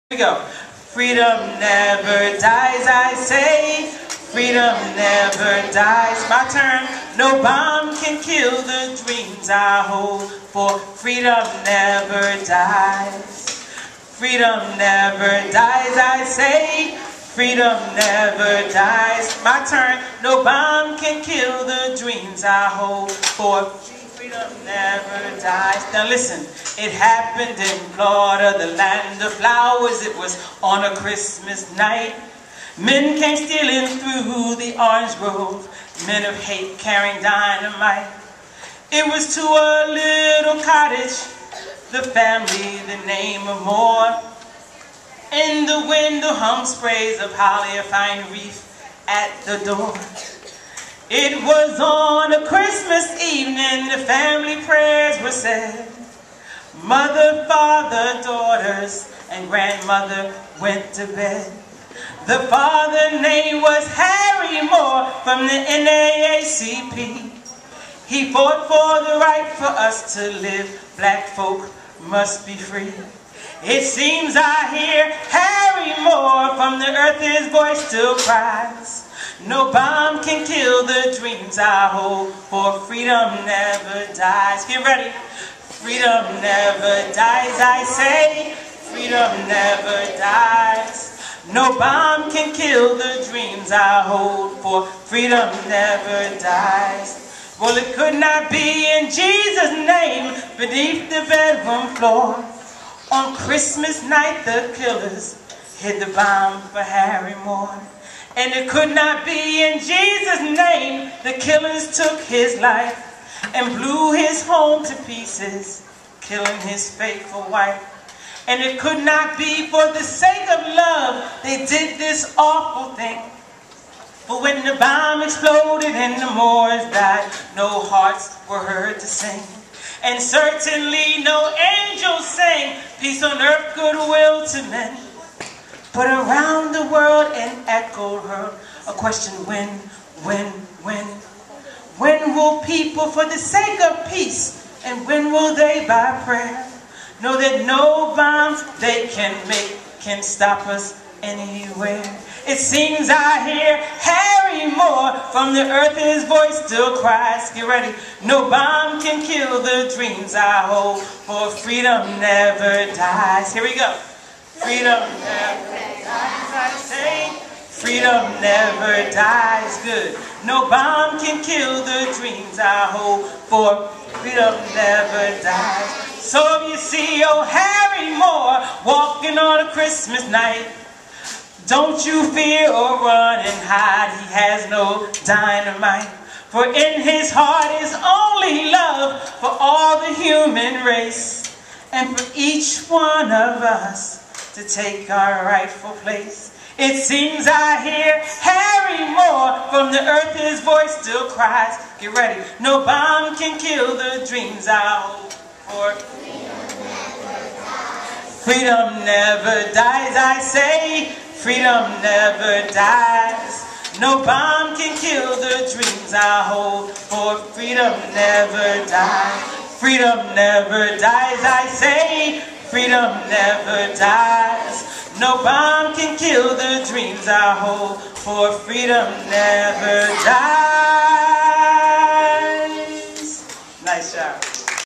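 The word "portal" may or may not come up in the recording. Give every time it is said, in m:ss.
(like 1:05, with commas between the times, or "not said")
not said.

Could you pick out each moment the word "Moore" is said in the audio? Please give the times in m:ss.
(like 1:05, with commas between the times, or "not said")
0:43, 1:04, 1:16, 1:47, 2:06, 2:34, 2:58, 3:19.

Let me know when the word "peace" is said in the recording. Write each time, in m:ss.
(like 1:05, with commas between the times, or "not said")
2:12, 2:24.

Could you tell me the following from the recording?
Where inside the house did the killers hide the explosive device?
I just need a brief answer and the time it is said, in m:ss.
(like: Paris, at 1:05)
Beneath the bedroom floor, at 1:40.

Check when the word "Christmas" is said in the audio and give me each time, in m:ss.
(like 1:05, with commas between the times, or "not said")
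0:30, 0:52, 1:43, 2:59.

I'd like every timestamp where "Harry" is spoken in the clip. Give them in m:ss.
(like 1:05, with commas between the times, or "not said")
1:03, 1:15, 1:46, 2:33, 2:57, 3:18.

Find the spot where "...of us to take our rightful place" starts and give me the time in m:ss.
3:13.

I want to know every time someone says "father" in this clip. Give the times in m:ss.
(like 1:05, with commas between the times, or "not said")
0:57, 1:02.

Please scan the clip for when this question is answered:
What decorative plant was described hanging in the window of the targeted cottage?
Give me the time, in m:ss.
0:47.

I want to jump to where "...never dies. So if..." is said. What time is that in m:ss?
2:54.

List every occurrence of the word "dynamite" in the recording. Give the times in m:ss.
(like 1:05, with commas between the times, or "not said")
0:37, 3:05.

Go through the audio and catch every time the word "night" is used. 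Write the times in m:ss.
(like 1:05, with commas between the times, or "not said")
0:31, 1:44, 3:00.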